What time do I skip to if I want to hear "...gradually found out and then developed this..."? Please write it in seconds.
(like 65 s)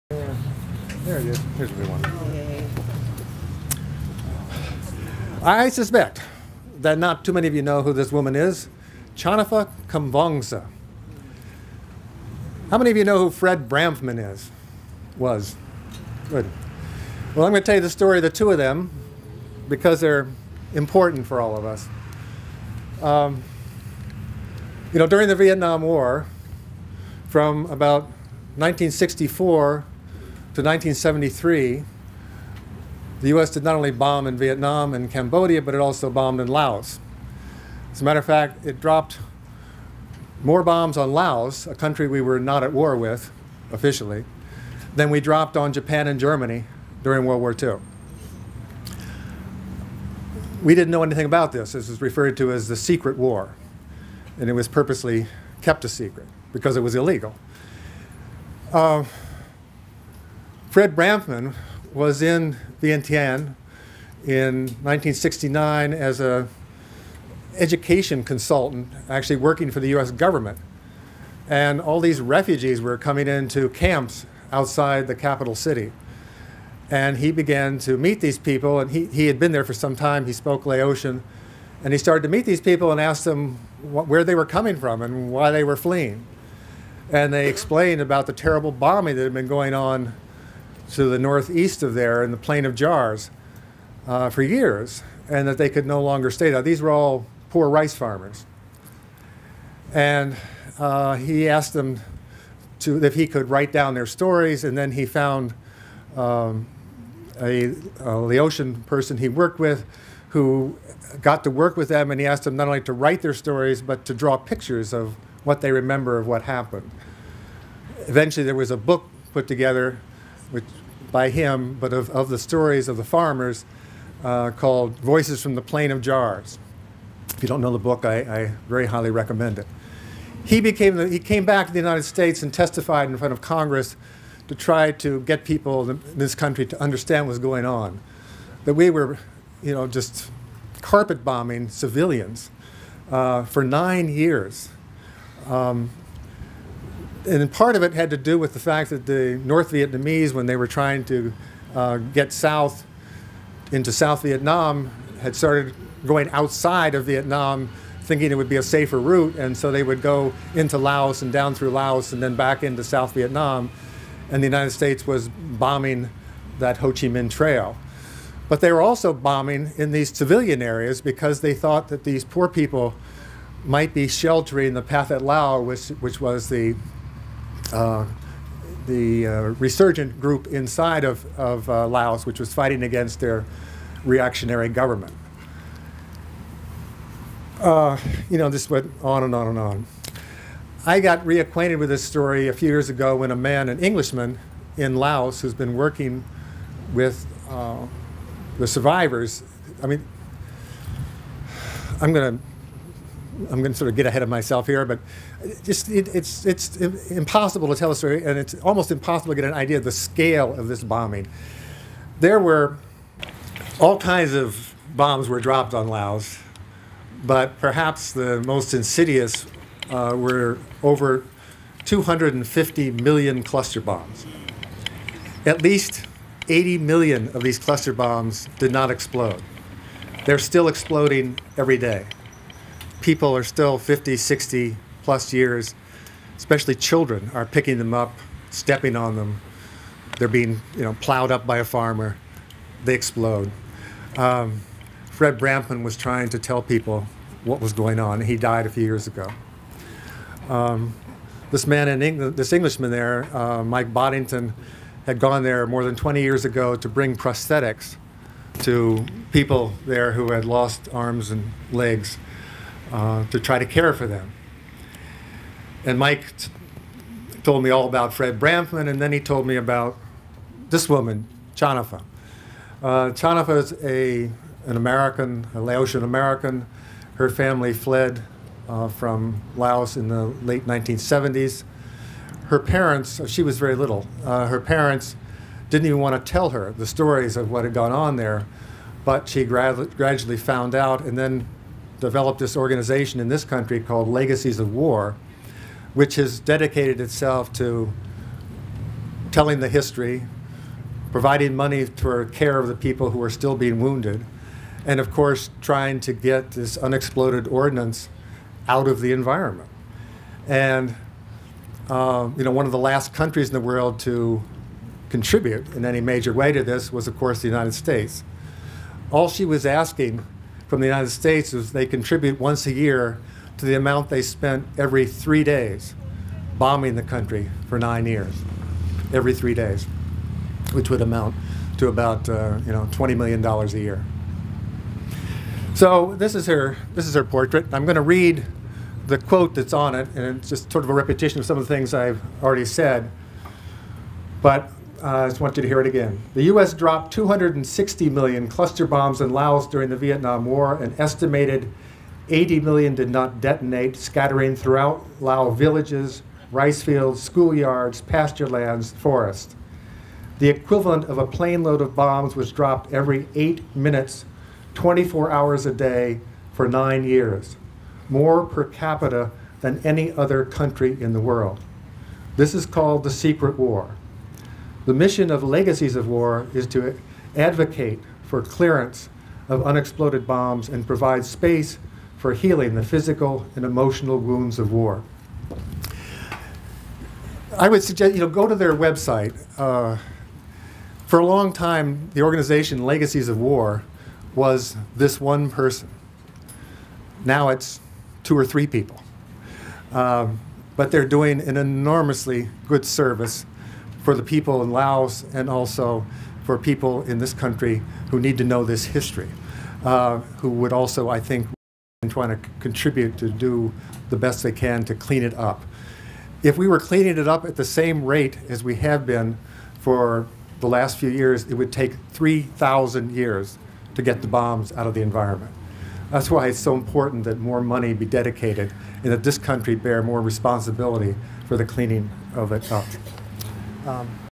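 289 s.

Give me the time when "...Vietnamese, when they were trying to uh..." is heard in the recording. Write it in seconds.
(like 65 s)
149 s.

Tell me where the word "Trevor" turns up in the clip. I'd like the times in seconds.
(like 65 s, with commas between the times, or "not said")
not said.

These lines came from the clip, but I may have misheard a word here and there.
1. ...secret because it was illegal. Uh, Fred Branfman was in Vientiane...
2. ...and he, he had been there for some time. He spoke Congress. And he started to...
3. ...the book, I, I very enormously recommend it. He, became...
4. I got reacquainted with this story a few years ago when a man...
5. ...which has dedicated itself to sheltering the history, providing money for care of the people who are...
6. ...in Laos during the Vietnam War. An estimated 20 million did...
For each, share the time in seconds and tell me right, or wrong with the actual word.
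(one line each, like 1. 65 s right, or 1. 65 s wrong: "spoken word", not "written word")
1. 55 s right
2. 78 s wrong: "Laotian", not "Congress"
3. 127 s wrong: "highly", not "enormously"
4. 190 s right
5. 295 s wrong: "telling", not "sheltering"
6. 349 s wrong: "80", not "20".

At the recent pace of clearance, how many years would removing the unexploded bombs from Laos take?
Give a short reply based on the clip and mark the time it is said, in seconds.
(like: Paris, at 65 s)
3,000 years, at 422 s.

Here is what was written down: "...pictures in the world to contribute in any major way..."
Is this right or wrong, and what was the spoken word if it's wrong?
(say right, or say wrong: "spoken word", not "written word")
wrong: "countries", not "pictures".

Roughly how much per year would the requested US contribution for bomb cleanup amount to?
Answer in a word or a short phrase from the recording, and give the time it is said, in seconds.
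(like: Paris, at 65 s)
$20 million, at 332 s.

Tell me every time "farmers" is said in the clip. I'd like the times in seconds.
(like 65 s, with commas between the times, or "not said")
97 s, 123 s, 241 s.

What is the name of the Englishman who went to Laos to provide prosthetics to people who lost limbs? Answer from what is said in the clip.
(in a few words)
Mike Boddington.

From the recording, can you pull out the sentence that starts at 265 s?
And Mike told me all about Fred Branfman, and then he told me about this woman, Channapha.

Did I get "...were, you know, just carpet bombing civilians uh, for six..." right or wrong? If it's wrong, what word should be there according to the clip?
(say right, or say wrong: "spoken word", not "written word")
wrong: "nine", not "six".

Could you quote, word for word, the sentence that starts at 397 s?
Now it's two or three people.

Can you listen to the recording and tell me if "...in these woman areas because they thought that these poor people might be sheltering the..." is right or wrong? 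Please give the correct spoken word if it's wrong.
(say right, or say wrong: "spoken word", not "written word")
wrong: "civilian", not "woman".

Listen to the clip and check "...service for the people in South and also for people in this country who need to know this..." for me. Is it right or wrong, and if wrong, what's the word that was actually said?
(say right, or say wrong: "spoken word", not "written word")
wrong: "Laos", not "South".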